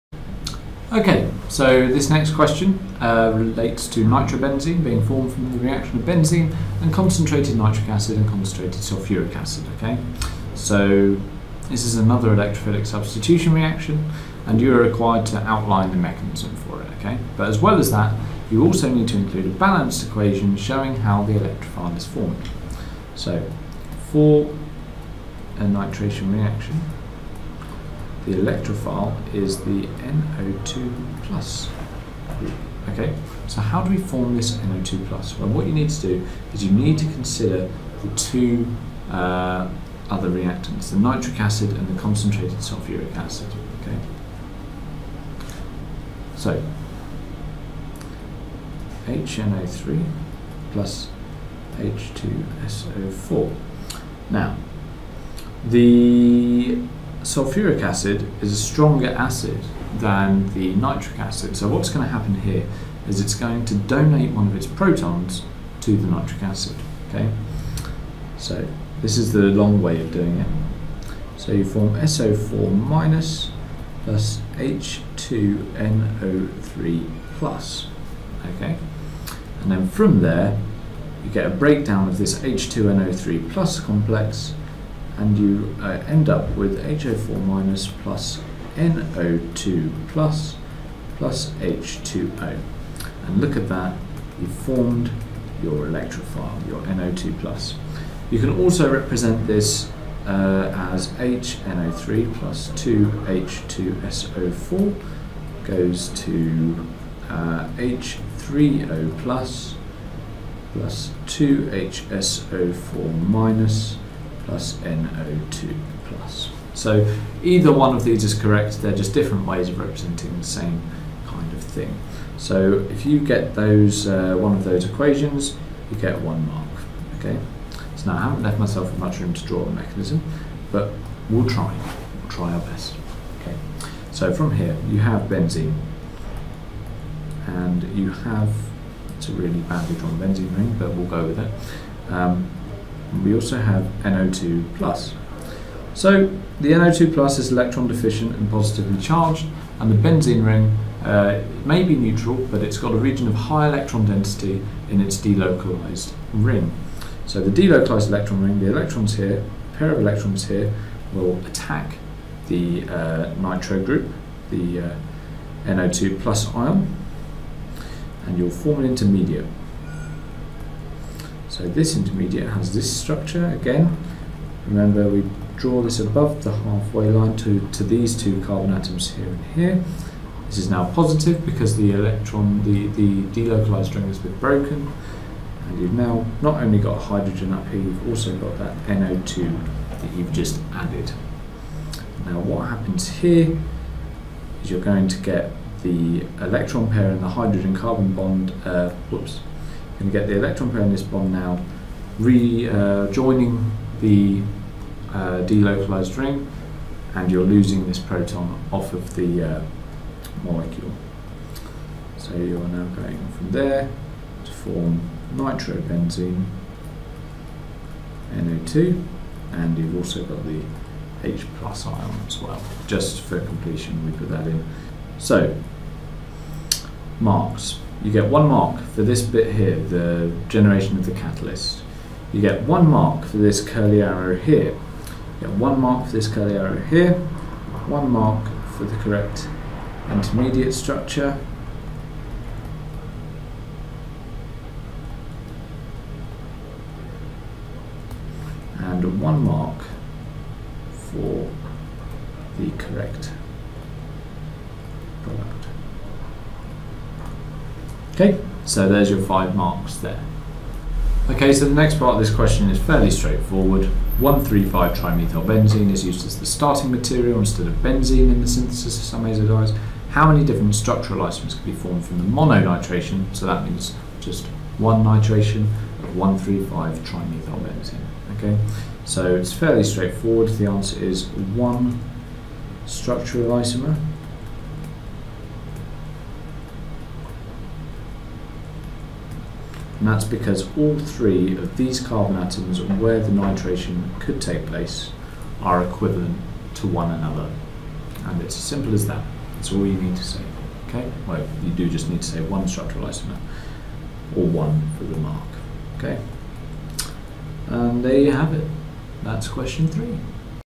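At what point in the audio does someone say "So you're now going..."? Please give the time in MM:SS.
03:32.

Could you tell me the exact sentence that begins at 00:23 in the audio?
So for a nitration reaction, the electrophile is the NO2 plus group.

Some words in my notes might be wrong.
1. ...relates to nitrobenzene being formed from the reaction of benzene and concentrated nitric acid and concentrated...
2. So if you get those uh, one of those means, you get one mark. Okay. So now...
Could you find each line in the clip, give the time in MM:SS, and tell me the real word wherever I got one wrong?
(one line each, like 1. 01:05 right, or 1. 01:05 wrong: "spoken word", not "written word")
1. 00:03 right
2. 02:02 wrong: "equations", not "means".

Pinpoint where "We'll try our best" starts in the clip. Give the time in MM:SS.
02:12.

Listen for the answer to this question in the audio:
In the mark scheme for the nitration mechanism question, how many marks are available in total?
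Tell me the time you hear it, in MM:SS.
04:19.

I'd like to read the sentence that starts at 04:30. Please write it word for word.
How many different structural isomers can be formed from the mononitration?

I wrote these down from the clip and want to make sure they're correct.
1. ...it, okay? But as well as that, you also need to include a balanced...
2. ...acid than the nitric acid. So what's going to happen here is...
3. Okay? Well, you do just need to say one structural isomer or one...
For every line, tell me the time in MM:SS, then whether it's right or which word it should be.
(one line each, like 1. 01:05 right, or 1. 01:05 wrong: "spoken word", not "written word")
1. 00:16 right
2. 00:59 right
3. 05:00 right.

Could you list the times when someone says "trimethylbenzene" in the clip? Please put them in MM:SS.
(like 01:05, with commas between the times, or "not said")
04:24, 04:36.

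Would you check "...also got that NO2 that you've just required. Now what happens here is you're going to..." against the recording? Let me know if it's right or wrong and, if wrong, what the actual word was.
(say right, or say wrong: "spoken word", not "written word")
wrong: "added", not "required".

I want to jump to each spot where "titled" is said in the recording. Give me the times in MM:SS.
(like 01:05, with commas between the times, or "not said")
not said.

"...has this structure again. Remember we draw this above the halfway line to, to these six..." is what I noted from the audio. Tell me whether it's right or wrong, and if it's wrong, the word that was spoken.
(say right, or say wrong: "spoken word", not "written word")
wrong: "two", not "six".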